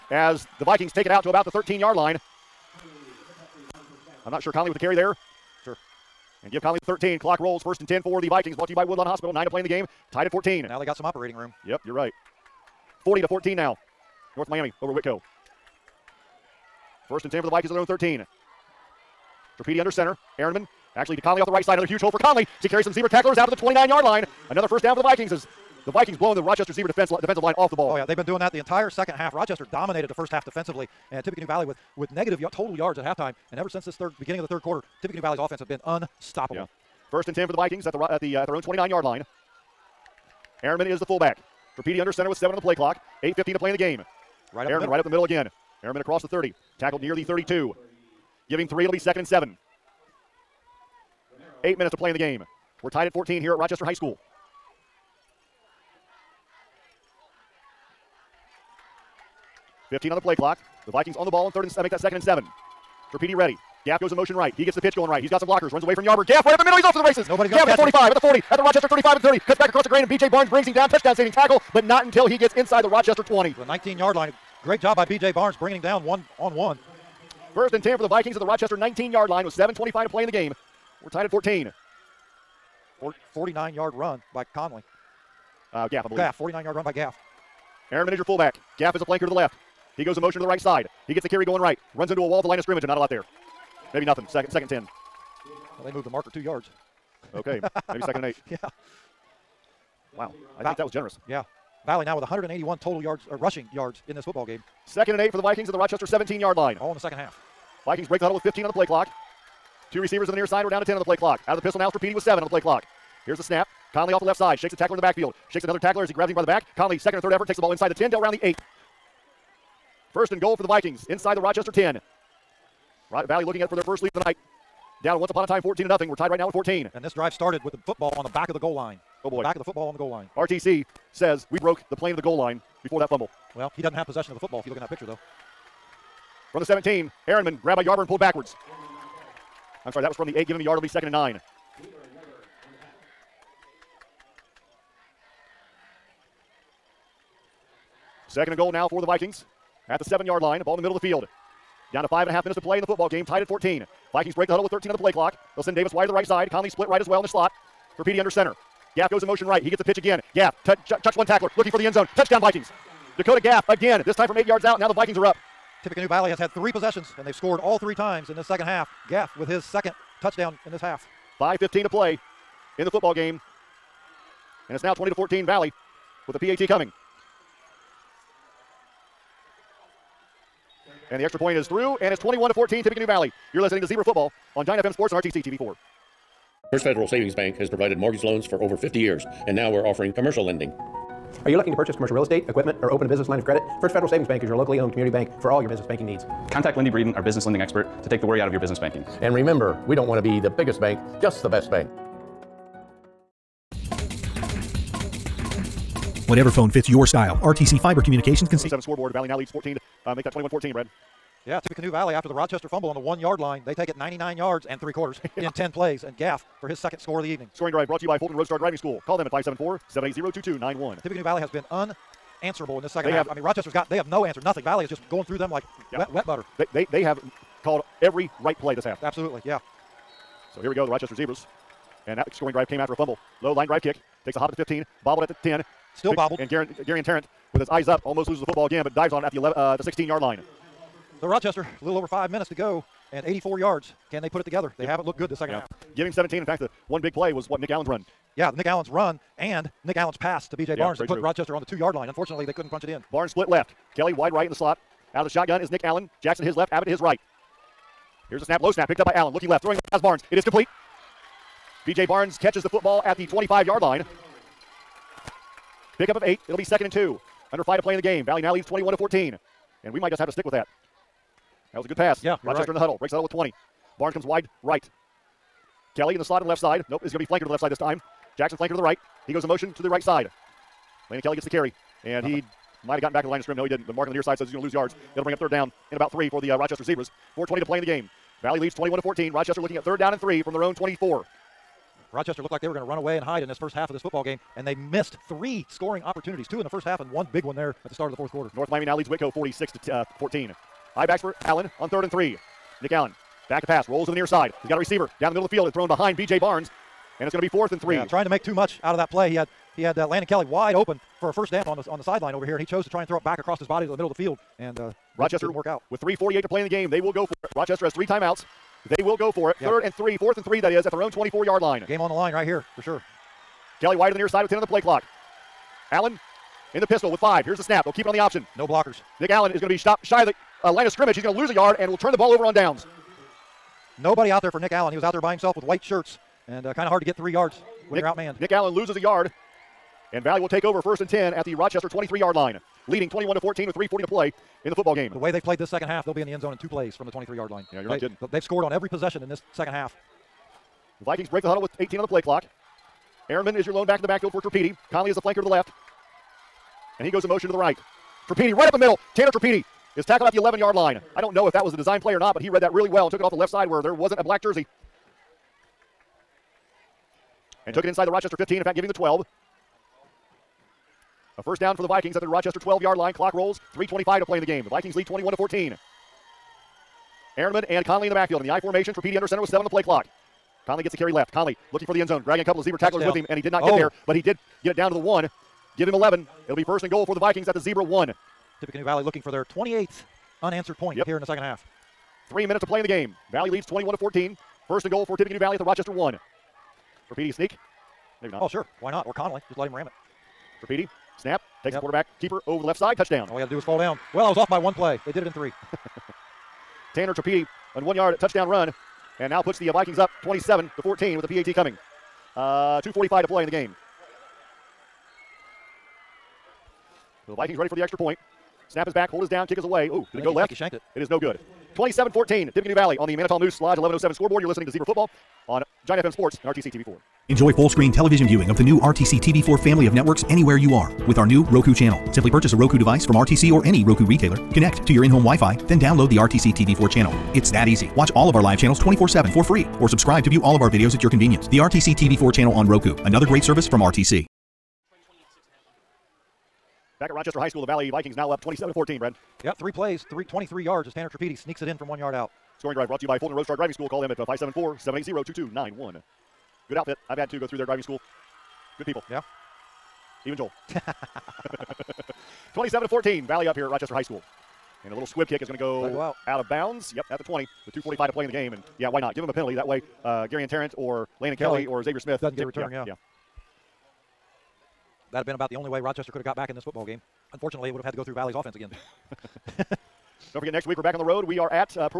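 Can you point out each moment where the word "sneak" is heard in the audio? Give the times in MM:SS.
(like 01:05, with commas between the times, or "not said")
06:37, 07:31.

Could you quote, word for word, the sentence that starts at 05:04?
He's got a receiver down the middle of the field and thrown behind B.J.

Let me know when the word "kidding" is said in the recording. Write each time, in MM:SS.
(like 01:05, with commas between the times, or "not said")
05:48.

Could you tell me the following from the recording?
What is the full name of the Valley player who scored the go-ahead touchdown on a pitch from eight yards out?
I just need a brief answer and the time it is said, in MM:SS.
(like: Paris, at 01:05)
Dakota Gaff, at 02:43.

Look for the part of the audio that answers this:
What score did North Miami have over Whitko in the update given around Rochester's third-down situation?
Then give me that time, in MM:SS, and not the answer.
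04:59.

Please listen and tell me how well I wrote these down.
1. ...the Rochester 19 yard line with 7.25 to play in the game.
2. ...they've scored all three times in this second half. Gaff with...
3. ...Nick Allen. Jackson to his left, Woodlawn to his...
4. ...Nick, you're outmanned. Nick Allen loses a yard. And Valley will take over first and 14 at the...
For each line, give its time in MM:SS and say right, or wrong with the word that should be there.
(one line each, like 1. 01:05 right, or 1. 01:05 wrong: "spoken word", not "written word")
1. 01:18 right
2. 02:47 right
3. 04:15 wrong: "Abbott", not "Woodlawn"
4. 05:37 wrong: "10", not "14".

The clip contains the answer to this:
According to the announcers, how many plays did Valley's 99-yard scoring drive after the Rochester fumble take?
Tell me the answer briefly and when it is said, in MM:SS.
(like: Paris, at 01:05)
10, at 03:35.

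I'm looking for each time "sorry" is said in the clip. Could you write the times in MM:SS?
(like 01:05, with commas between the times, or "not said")
02:19.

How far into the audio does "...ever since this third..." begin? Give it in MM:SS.
00:33.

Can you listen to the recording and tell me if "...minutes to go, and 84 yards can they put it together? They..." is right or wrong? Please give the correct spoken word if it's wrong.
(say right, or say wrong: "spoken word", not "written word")
right.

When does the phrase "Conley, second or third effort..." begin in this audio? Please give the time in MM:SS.
01:56.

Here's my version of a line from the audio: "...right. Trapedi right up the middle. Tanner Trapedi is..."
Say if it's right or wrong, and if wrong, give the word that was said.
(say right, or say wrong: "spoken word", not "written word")
right.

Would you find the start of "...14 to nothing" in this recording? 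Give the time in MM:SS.
02:05.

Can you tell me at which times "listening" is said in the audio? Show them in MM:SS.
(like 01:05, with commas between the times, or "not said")
03:03, 07:04.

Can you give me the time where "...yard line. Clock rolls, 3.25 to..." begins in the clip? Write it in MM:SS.
06:12.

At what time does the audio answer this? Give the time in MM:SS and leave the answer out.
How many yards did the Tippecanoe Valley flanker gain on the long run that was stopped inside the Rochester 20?
01:26.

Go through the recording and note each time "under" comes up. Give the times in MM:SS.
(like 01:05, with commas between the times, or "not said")
00:19, 00:42, 02:38, 04:27, 06:19.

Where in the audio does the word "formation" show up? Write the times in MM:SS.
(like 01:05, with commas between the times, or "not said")
06:18.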